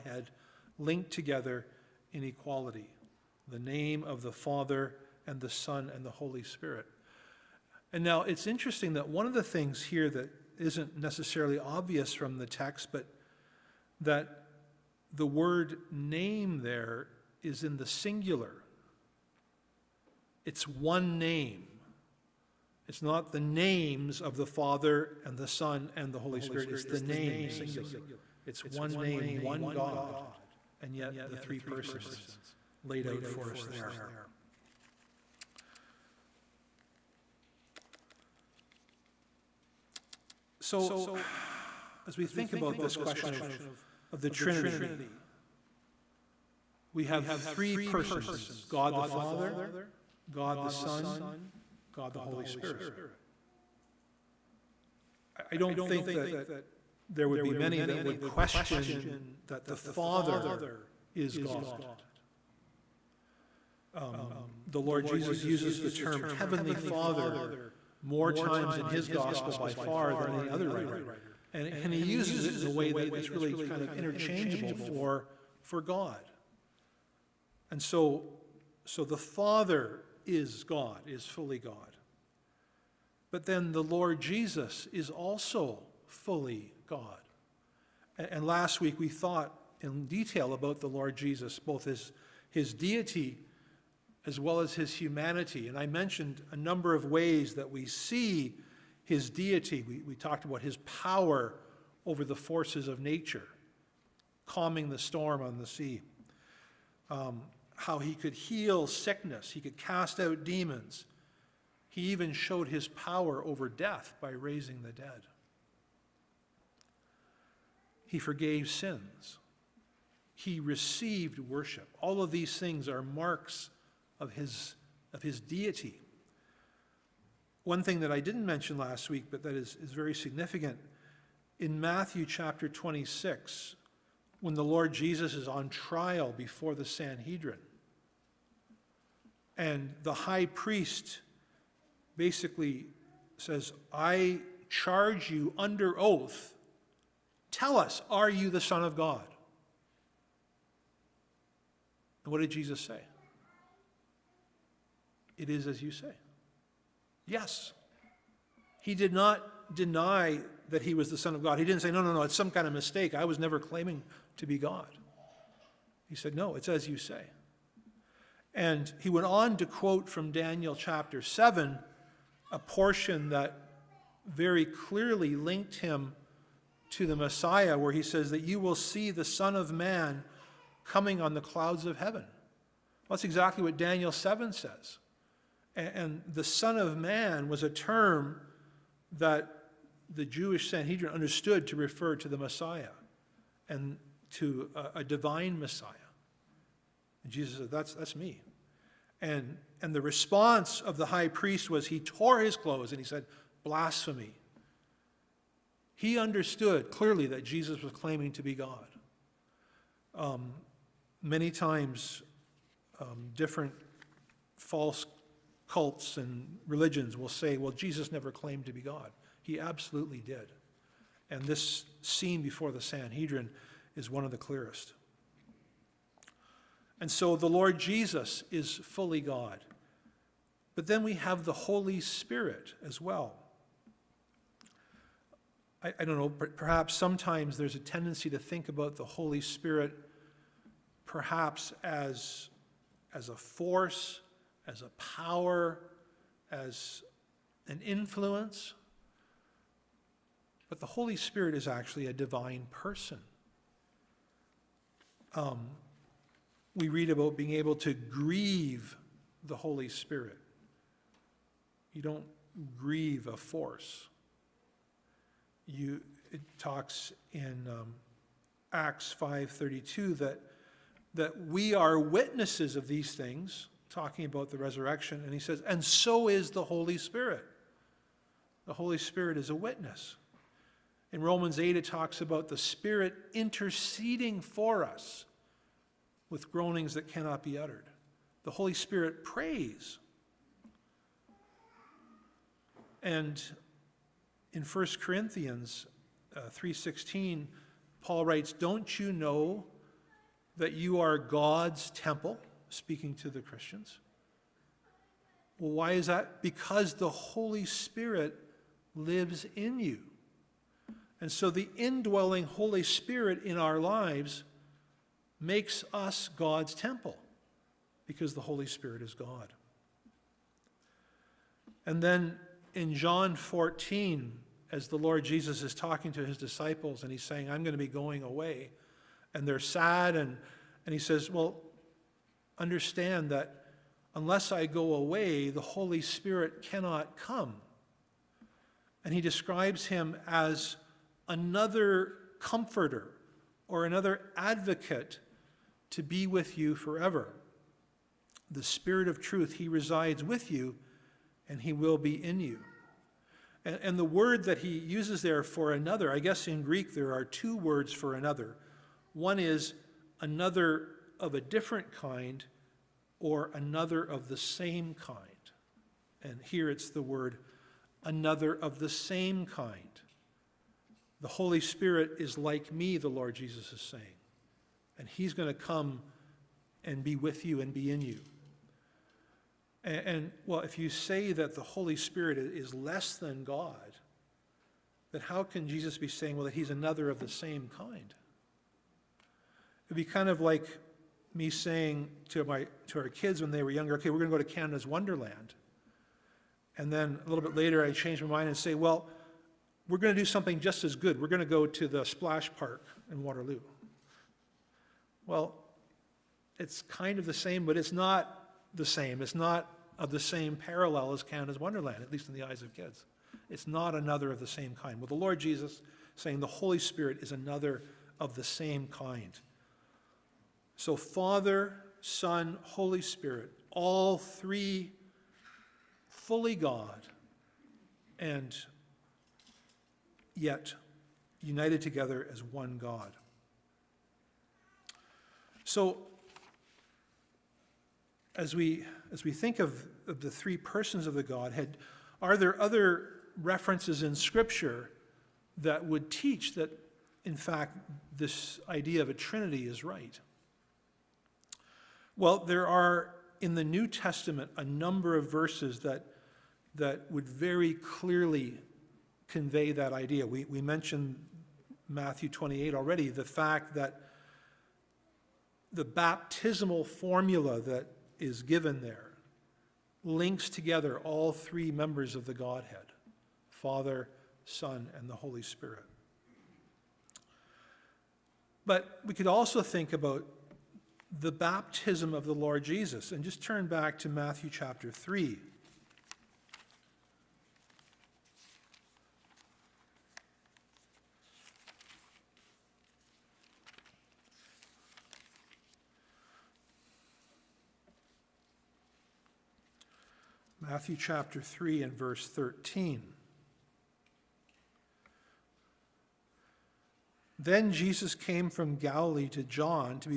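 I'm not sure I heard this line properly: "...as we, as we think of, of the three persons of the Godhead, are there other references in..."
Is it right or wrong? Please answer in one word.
right.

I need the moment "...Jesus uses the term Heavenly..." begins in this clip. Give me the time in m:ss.
1:05.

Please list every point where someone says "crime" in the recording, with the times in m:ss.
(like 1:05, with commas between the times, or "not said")
not said.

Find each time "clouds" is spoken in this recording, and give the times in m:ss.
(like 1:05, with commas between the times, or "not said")
3:01.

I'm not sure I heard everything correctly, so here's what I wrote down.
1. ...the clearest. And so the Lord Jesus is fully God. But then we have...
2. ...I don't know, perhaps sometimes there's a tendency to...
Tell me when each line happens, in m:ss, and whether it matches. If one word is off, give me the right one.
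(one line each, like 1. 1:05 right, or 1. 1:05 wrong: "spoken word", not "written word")
1. 3:44 right
2. 3:55 right.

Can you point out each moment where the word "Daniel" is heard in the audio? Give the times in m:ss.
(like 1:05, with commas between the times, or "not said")
2:50, 3:03.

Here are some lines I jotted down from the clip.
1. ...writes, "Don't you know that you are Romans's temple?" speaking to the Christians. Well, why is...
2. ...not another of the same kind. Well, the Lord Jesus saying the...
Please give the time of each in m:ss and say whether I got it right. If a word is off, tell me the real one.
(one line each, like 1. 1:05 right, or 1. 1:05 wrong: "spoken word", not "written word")
1. 4:58 wrong: "God", not "Romans"
2. 6:53 right.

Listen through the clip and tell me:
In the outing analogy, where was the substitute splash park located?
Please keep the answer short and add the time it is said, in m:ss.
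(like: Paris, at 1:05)
Waterloo, at 6:43.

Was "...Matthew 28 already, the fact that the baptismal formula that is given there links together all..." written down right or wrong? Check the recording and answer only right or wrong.
right.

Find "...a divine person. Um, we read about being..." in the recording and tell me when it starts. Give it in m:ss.
4:12.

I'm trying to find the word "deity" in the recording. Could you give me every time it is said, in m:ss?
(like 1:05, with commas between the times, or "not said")
1:32, 1:39, 2:05.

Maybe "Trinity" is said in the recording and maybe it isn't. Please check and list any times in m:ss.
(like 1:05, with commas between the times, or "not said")
0:44, 7:29.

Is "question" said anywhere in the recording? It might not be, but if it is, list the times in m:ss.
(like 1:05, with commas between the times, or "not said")
0:42, 0:58.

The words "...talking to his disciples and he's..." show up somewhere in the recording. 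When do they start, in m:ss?
5:25.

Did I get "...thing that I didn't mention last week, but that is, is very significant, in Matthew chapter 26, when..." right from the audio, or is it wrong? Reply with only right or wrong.
right.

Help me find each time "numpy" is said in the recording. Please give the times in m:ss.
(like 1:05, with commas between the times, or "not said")
not said.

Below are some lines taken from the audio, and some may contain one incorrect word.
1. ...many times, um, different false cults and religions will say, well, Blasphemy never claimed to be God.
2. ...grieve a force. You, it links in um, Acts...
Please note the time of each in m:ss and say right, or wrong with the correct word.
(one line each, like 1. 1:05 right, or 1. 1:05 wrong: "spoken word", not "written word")
1. 3:31 wrong: "Jesus", not "Blasphemy"
2. 4:22 wrong: "talks", not "links".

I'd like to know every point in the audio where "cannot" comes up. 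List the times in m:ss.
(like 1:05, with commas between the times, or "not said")
4:47, 5:36.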